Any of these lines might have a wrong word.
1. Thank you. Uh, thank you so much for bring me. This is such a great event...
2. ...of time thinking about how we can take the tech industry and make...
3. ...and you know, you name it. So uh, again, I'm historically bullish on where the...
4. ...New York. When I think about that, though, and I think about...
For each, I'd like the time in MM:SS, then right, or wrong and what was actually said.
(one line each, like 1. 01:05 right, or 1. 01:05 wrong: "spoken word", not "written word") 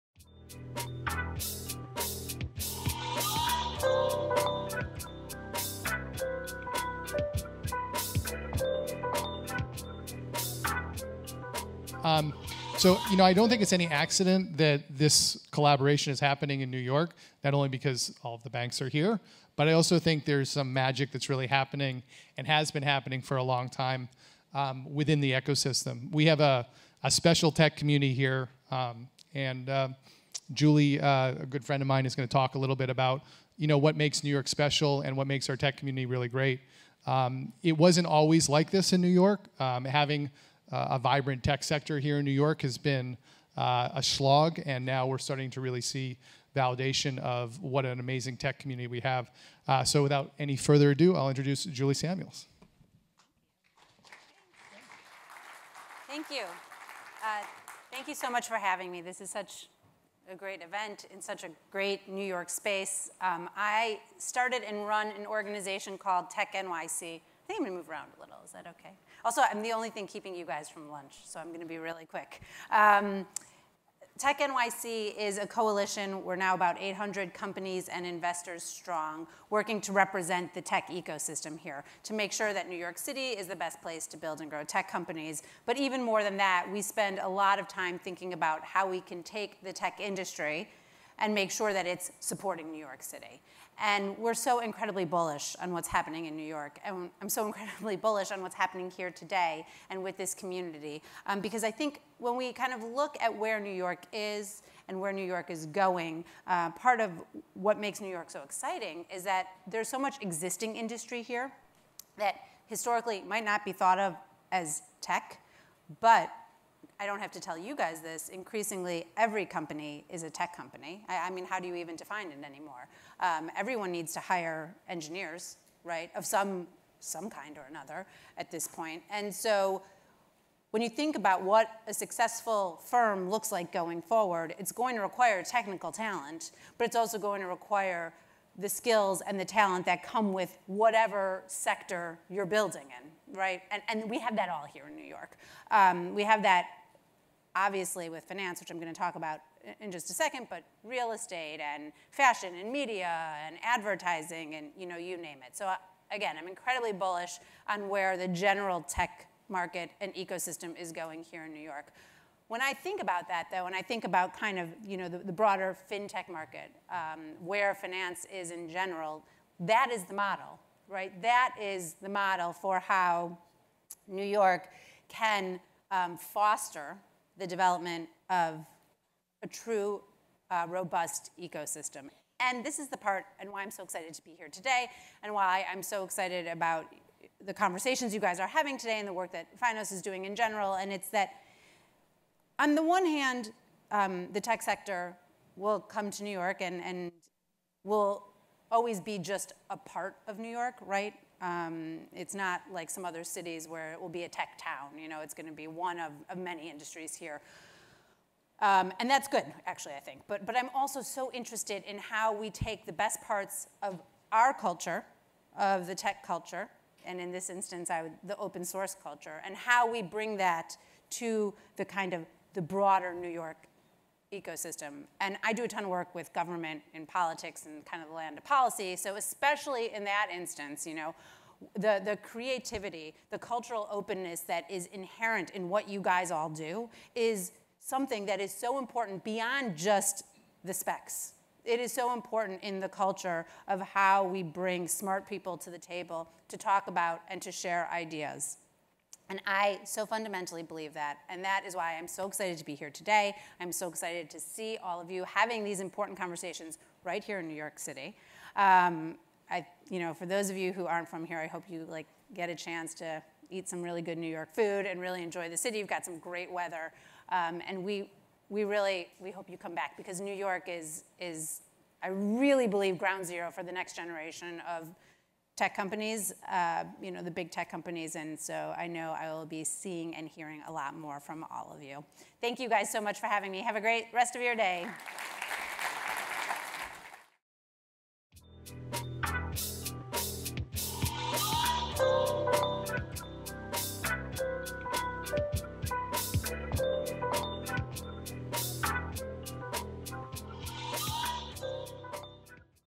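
1. 00:56 wrong: "having", not "bring"
2. 01:27 right
3. 02:34 wrong: "incredibly", not "historically"
4. 02:41 right.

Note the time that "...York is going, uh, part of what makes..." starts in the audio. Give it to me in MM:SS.
01:45.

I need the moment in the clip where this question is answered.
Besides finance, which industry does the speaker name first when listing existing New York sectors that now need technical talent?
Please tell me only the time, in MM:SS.
02:30.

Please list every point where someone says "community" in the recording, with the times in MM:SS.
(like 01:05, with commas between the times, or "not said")
00:27, 00:35, 00:48, 01:40.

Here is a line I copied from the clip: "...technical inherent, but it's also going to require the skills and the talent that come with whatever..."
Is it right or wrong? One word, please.
wrong.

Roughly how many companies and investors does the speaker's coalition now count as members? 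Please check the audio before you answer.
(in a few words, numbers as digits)
800.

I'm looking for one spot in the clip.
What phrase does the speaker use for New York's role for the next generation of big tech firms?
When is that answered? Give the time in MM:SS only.
04:32.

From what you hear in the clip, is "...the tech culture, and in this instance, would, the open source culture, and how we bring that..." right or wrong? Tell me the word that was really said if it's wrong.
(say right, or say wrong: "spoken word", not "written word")
right.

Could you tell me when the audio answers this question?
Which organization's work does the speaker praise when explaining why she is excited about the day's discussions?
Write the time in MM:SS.
03:09.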